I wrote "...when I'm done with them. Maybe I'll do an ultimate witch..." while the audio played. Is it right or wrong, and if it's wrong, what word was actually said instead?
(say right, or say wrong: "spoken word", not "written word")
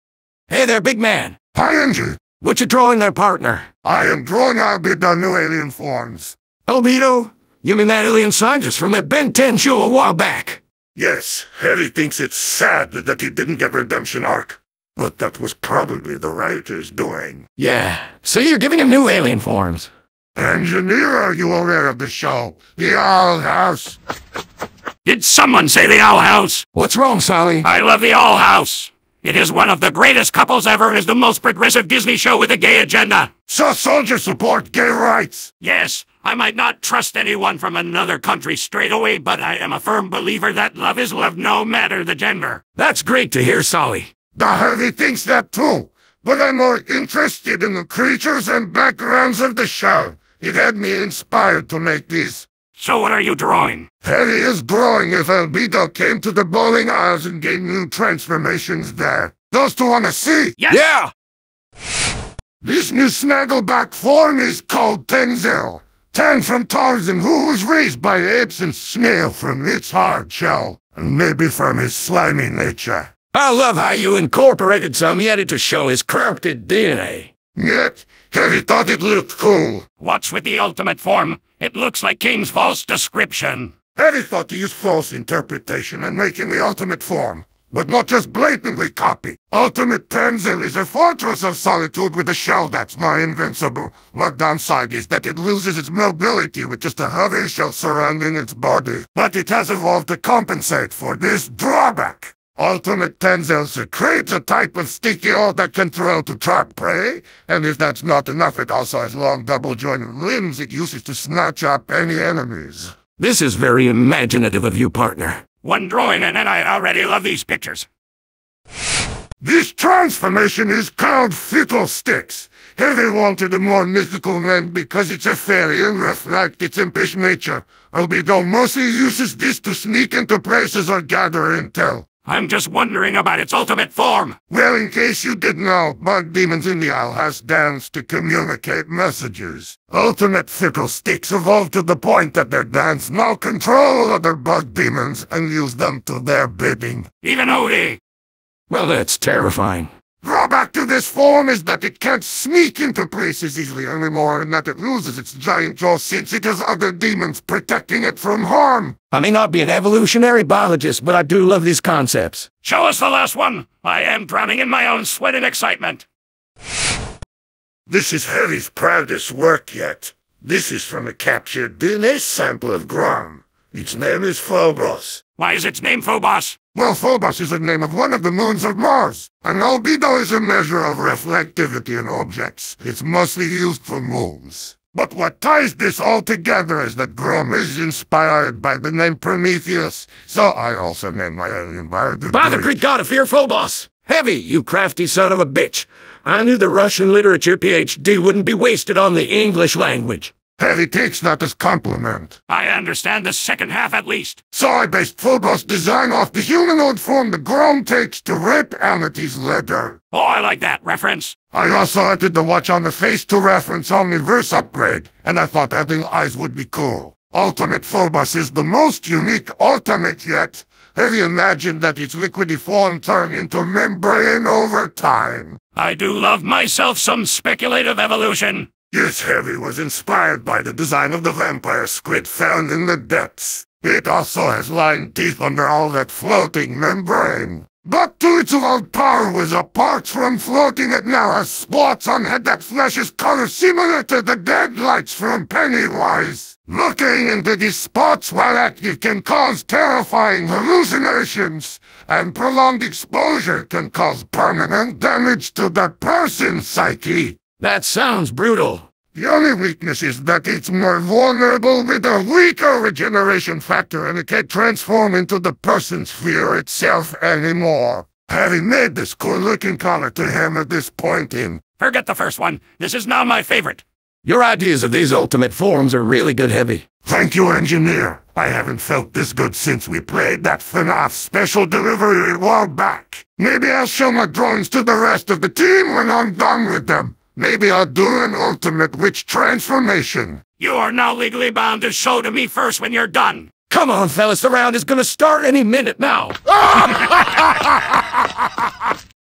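right.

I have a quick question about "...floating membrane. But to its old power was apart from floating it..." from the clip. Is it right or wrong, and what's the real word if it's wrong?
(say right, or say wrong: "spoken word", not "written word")
right.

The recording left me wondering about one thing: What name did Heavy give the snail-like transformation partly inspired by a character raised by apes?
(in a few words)
Tenzel.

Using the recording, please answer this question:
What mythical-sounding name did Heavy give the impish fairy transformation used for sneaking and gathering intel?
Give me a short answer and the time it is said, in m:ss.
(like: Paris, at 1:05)
Fiddlesticks, at 2:01.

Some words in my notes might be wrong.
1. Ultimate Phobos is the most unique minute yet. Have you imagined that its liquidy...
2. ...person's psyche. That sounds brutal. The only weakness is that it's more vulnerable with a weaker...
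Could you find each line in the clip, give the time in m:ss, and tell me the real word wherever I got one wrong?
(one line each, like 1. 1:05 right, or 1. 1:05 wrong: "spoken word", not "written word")
1. 3:37 wrong: "ultimate", not "minute"
2. 4:16 right.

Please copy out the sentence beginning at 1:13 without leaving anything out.
I love how you incorporated some yeti to show his corrupted DNA.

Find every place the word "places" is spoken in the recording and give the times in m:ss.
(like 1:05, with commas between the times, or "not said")
2:10, 2:33.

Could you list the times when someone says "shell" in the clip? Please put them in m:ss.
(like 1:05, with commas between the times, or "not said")
1:10, 1:32, 1:37.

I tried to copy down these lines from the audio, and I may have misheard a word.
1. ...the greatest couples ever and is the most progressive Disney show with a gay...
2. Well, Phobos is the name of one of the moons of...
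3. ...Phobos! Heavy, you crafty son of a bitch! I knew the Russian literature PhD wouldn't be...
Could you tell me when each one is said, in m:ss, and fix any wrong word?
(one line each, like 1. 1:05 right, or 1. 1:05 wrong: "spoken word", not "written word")
1. 0:29 right
2. 2:56 right
3. 3:13 right.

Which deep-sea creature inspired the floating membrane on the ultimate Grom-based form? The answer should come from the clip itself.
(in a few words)
vampire squid.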